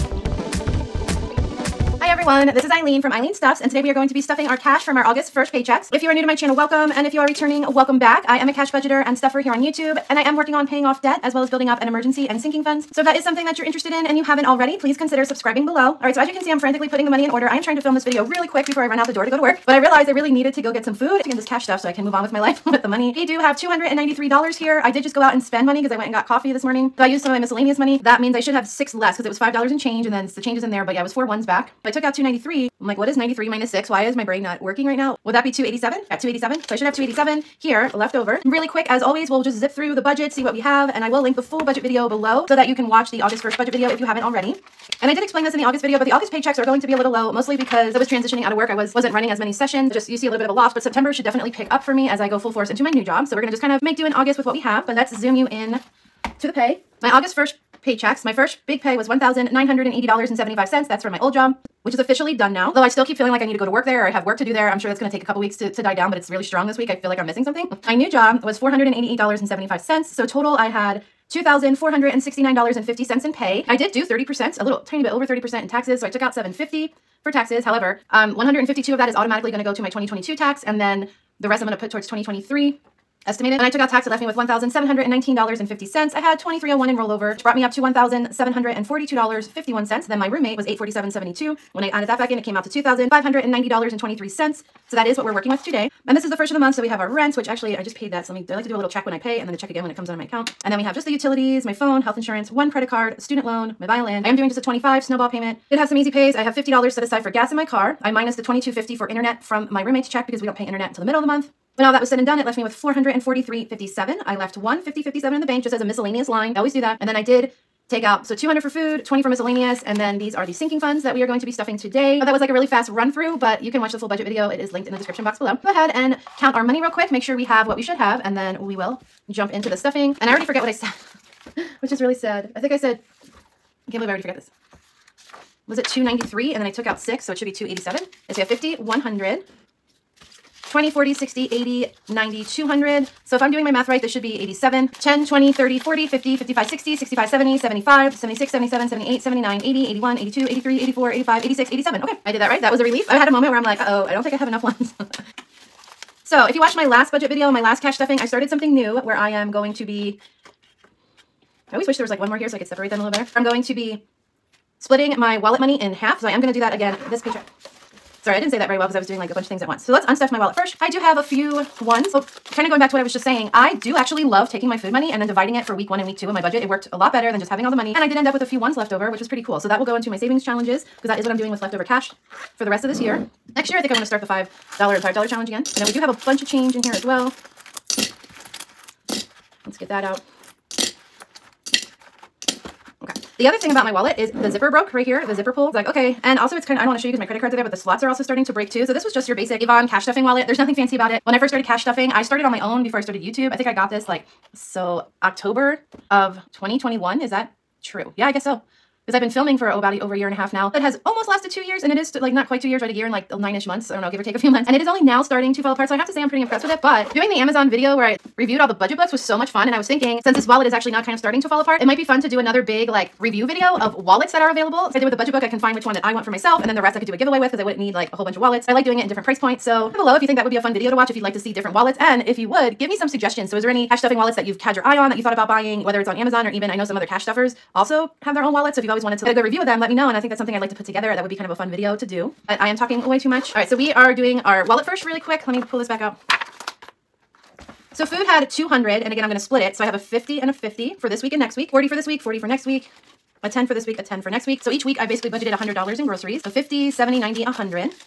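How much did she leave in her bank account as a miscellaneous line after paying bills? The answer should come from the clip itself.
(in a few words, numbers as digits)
$150.57.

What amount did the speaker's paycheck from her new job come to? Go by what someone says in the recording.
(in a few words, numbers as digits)
$488.75.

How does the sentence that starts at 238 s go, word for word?
So if you've always wanted to get a good review of them, let me know.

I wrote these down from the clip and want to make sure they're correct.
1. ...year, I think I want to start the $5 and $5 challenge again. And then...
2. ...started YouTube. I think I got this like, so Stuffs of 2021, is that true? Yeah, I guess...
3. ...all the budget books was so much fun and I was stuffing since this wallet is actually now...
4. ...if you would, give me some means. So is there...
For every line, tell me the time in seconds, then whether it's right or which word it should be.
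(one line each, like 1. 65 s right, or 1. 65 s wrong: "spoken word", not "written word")
1. 183 s right
2. 203 s wrong: "October", not "Stuffs"
3. 218 s wrong: "thinking", not "stuffing"
4. 232 s wrong: "suggestions", not "means".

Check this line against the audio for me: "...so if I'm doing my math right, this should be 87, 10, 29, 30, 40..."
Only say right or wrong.
wrong.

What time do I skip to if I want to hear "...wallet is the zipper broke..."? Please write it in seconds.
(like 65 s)
193 s.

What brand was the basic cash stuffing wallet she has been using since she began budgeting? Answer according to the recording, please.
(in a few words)
Avon.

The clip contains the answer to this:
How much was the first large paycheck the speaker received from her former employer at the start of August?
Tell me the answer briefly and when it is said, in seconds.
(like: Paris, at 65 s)
$1,980.75, at 59 s.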